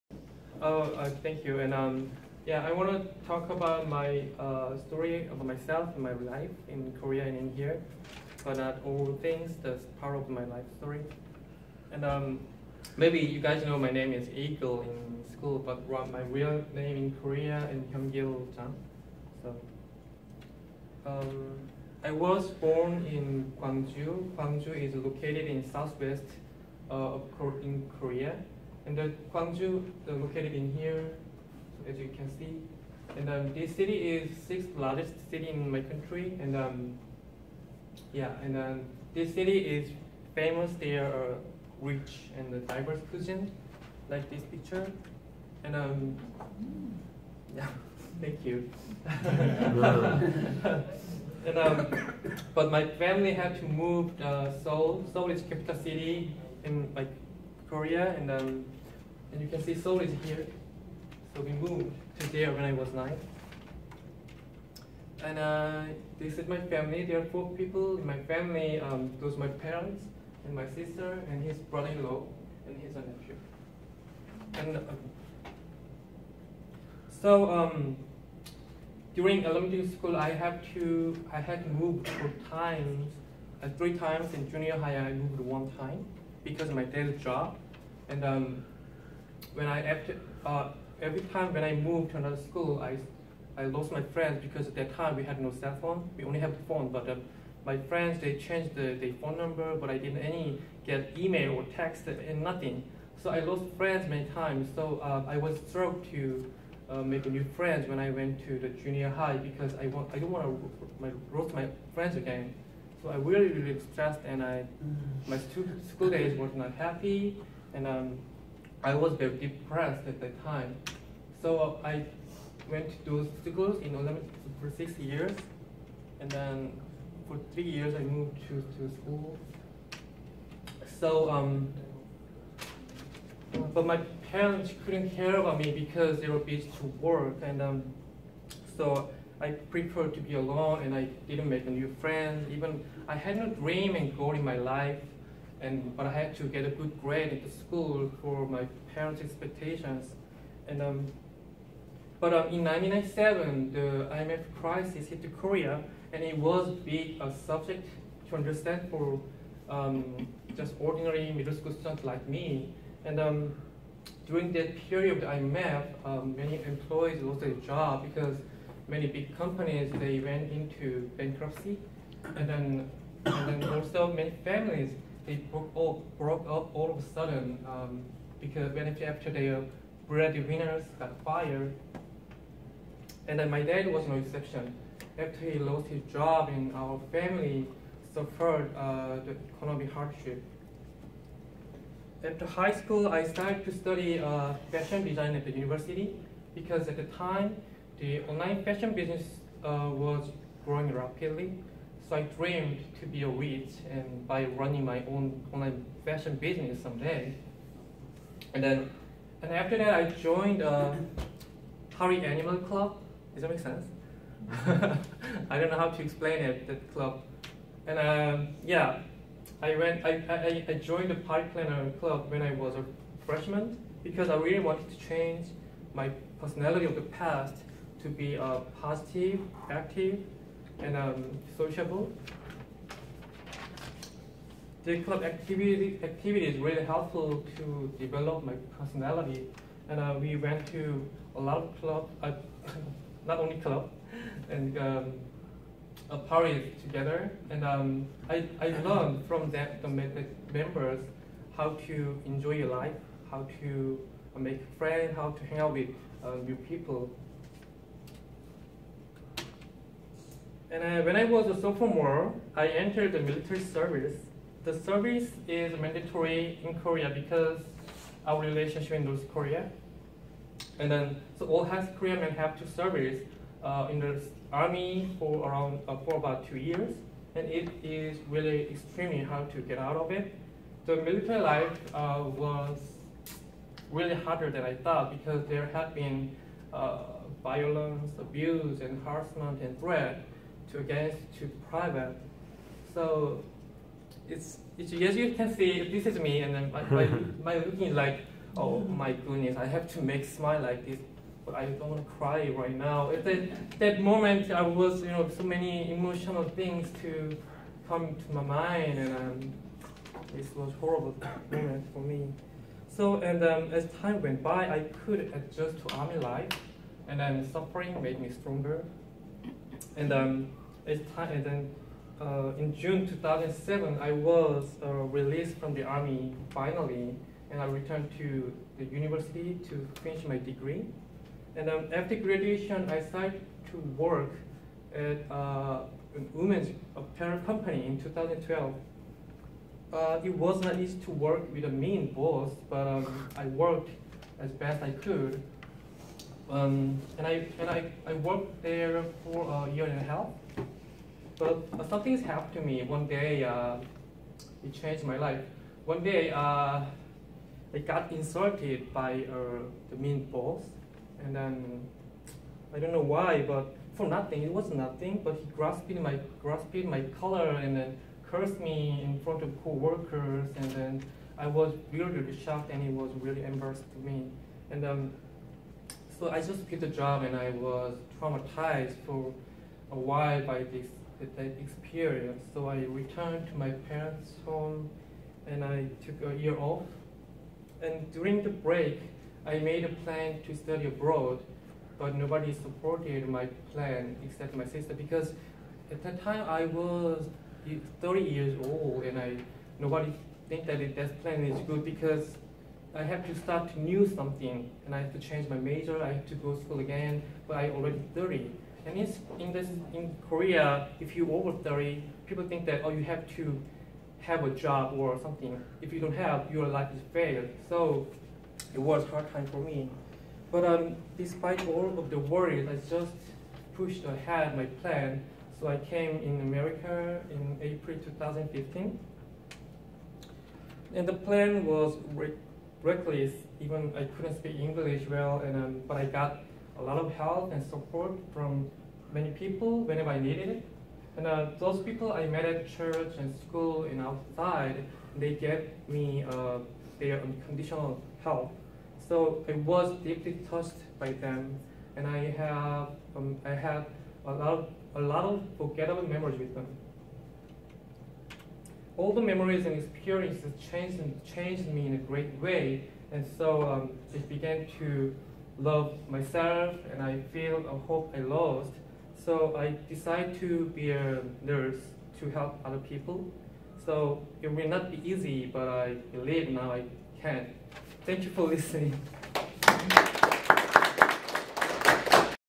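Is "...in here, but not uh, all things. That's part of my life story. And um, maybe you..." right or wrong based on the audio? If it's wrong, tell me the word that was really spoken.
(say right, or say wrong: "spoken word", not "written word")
right.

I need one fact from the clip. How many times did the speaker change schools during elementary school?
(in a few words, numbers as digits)
4.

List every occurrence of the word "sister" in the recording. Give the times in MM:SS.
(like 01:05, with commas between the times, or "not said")
01:10, 06:34.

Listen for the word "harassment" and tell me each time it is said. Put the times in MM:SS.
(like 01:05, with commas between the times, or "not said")
04:49.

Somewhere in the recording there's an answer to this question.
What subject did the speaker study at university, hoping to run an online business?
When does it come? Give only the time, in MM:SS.
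03:14.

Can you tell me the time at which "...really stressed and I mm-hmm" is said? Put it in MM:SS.
01:53.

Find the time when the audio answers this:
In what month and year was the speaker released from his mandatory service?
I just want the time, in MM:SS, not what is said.
05:22.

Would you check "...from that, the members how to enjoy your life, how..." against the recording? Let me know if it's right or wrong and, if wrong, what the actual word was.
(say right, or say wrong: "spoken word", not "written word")
right.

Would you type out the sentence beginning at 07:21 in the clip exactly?
And uh, those people I met at church and school and outside, they gave me uh, their unconditional help.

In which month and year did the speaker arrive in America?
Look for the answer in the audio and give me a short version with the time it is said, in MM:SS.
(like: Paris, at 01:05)
April 2015, at 07:07.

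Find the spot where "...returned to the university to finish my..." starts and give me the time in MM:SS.
05:27.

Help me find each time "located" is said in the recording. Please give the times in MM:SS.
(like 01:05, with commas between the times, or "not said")
00:24, 00:30.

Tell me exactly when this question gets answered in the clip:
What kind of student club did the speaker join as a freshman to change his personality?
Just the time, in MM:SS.
03:41.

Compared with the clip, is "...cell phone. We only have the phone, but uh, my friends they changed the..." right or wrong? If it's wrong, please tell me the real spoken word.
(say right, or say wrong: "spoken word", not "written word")
right.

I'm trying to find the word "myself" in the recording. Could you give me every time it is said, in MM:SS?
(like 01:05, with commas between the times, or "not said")
00:05, 07:46.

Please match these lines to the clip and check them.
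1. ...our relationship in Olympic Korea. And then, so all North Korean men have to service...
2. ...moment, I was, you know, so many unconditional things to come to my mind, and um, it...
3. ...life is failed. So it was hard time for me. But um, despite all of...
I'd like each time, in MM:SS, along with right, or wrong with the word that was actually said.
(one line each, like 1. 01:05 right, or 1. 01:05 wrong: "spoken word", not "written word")
1. 04:28 wrong: "North", not "Olympic"
2. 05:04 wrong: "emotional", not "unconditional"
3. 06:56 right.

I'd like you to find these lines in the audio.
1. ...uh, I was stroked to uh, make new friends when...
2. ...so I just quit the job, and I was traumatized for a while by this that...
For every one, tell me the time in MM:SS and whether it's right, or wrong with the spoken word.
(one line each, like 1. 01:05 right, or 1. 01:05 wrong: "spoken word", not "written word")
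1. 01:45 right
2. 06:16 right.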